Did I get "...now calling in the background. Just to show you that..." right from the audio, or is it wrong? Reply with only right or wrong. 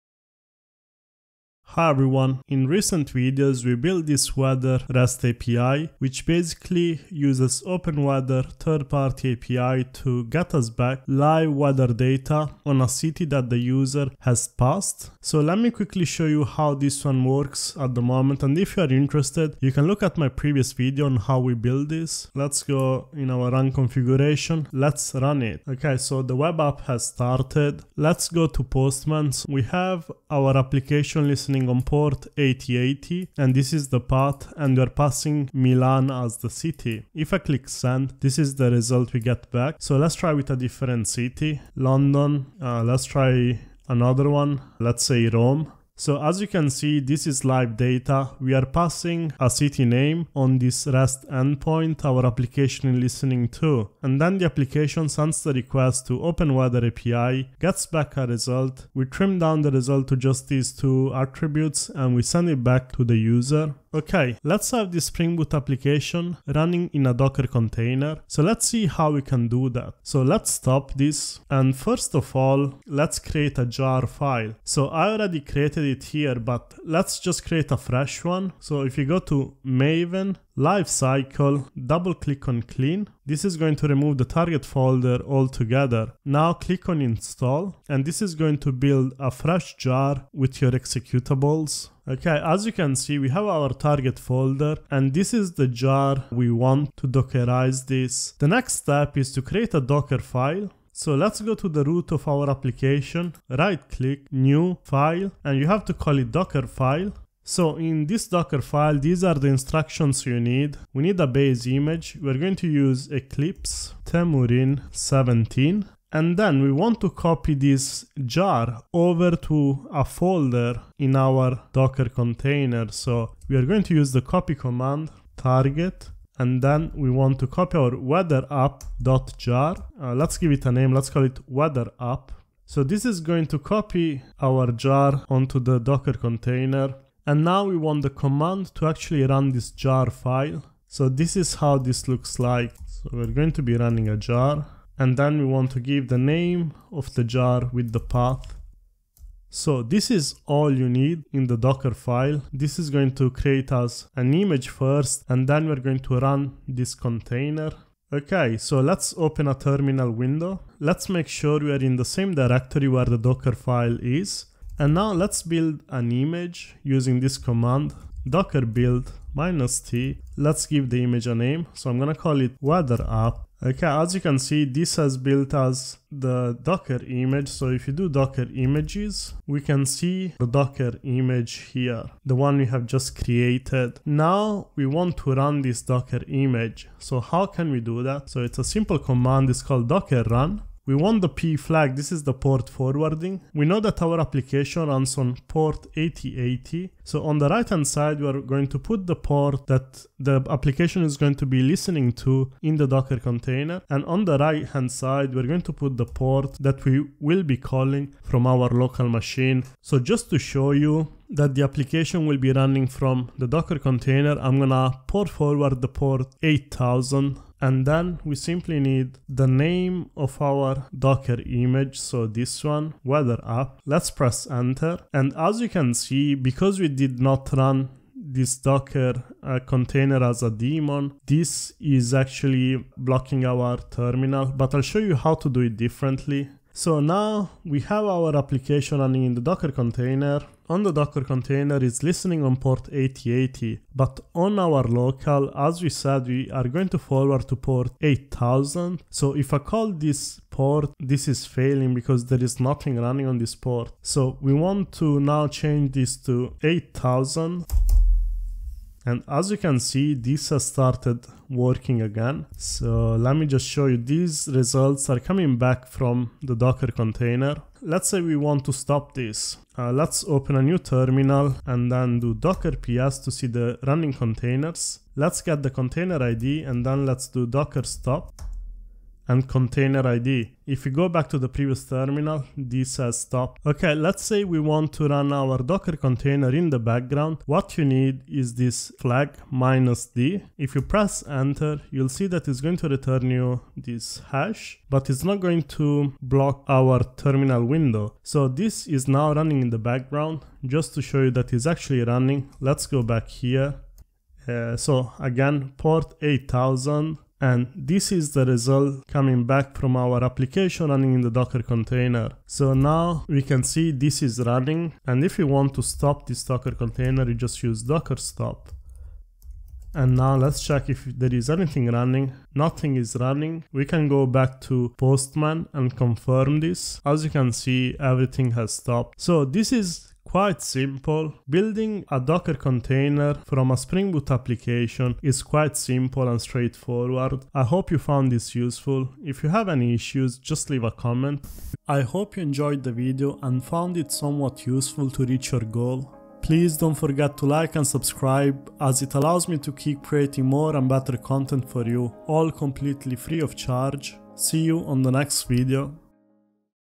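wrong.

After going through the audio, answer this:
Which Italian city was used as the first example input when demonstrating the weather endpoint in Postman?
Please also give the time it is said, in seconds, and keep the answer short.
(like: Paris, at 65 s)
Milan, at 35 s.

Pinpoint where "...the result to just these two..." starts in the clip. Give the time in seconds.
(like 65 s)
59 s.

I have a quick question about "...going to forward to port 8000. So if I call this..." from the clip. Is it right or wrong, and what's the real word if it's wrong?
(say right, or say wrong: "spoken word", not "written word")
right.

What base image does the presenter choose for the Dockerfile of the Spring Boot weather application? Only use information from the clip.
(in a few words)
Eclipse Temurin 17.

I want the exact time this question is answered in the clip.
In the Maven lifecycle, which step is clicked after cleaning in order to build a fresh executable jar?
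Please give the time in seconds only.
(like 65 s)
87 s.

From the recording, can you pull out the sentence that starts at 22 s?
Let's go in our run configuration, let's run it.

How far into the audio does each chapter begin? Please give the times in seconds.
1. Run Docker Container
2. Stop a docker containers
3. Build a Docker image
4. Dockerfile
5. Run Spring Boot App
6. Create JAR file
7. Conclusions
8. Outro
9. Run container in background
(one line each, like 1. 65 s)
1. 186 s
2. 314 s
3. 149 s
4. 98 s
5. 16 s
6. 72 s
7. 330 s
8. 341 s
9. 284 s.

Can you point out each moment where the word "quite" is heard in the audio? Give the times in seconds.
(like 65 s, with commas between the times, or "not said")
330 s, 335 s.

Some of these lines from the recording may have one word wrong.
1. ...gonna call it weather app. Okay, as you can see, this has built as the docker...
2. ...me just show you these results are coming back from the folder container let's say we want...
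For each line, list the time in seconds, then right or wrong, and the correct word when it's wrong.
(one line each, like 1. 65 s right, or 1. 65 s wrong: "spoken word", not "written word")
1. 171 s right
2. 263 s wrong: "docker", not "folder".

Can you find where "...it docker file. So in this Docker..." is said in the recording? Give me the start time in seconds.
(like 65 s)
106 s.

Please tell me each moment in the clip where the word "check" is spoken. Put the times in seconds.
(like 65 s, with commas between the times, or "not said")
320 s.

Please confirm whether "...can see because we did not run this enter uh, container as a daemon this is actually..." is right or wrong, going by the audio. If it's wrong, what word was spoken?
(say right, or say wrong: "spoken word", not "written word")
wrong: "docker", not "enter".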